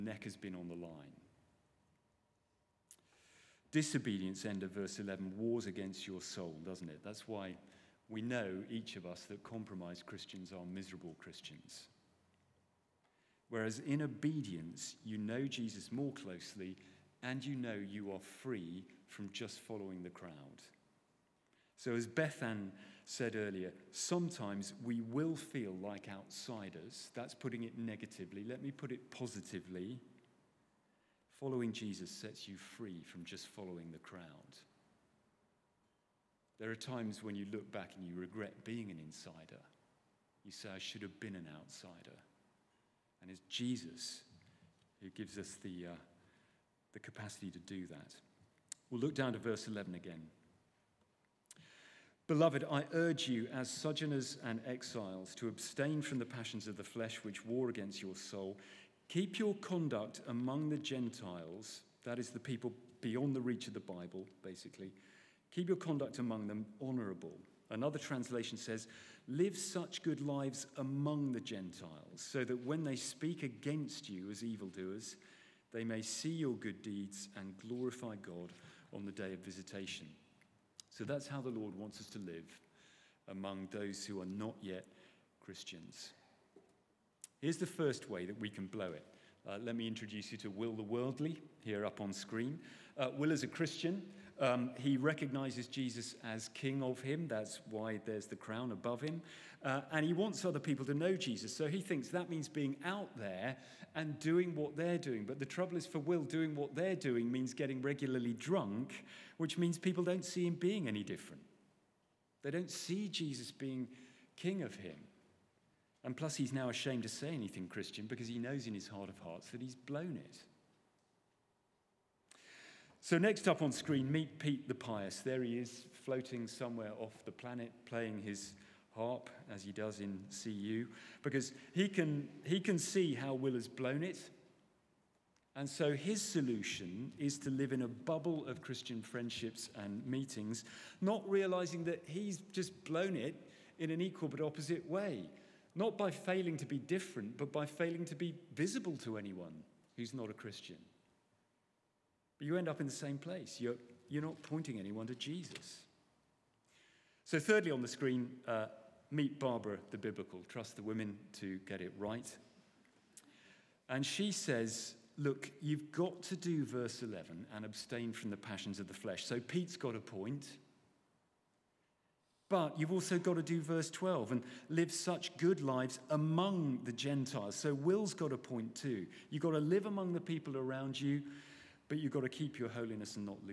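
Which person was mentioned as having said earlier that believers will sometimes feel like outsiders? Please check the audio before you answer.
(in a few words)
Bethan.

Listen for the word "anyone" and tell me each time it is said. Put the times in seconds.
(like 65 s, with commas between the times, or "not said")
149 s, 154 s.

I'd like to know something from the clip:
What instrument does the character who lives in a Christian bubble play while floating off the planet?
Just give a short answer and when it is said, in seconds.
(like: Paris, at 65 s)
Harp, at 128 s.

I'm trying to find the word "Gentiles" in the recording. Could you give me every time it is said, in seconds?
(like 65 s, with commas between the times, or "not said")
60 s, 71 s, 176 s.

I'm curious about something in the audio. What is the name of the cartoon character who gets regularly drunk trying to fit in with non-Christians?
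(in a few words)
Will the Worldly.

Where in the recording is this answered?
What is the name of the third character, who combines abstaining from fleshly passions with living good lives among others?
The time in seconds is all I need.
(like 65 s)
159 s.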